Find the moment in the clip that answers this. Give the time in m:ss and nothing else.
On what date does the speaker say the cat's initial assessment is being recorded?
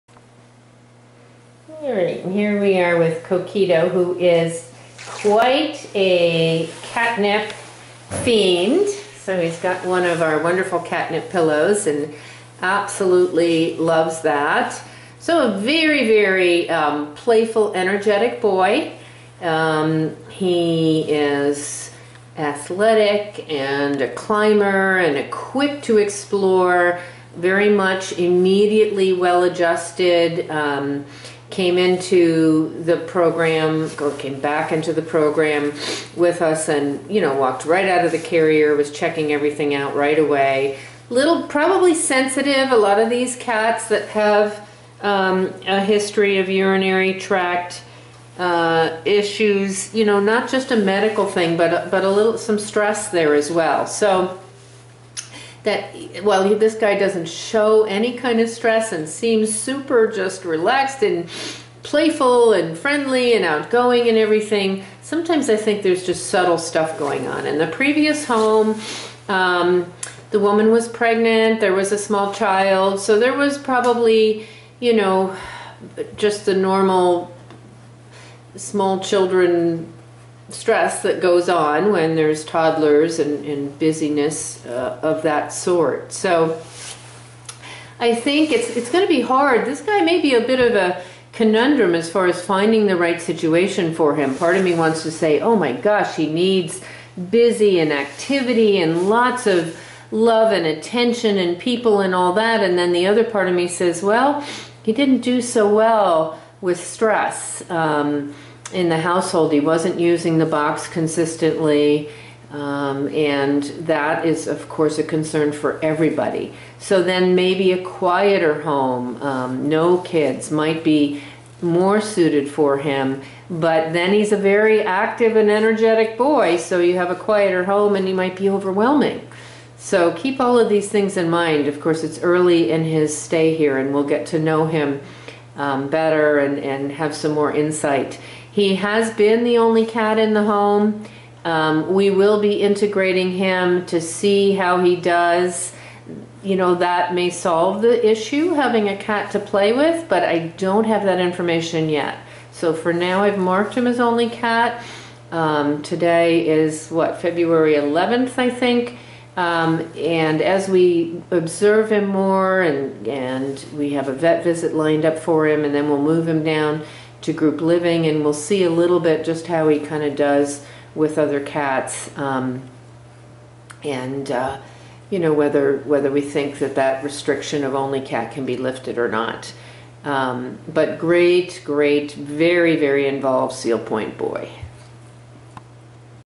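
2:37.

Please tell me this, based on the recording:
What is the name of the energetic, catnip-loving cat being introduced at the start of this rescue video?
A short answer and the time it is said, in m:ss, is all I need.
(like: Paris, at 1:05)
Coquito, at 0:03.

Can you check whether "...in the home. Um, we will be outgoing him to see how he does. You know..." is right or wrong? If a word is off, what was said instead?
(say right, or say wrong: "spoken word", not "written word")
wrong: "integrating", not "outgoing".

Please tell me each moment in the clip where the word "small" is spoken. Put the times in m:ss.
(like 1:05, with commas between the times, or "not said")
1:11, 1:18.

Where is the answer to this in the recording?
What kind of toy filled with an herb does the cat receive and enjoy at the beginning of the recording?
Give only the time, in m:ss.
0:10.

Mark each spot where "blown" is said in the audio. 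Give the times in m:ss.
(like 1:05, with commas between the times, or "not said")
not said.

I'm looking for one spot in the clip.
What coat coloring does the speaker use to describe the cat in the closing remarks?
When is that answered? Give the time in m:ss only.
3:03.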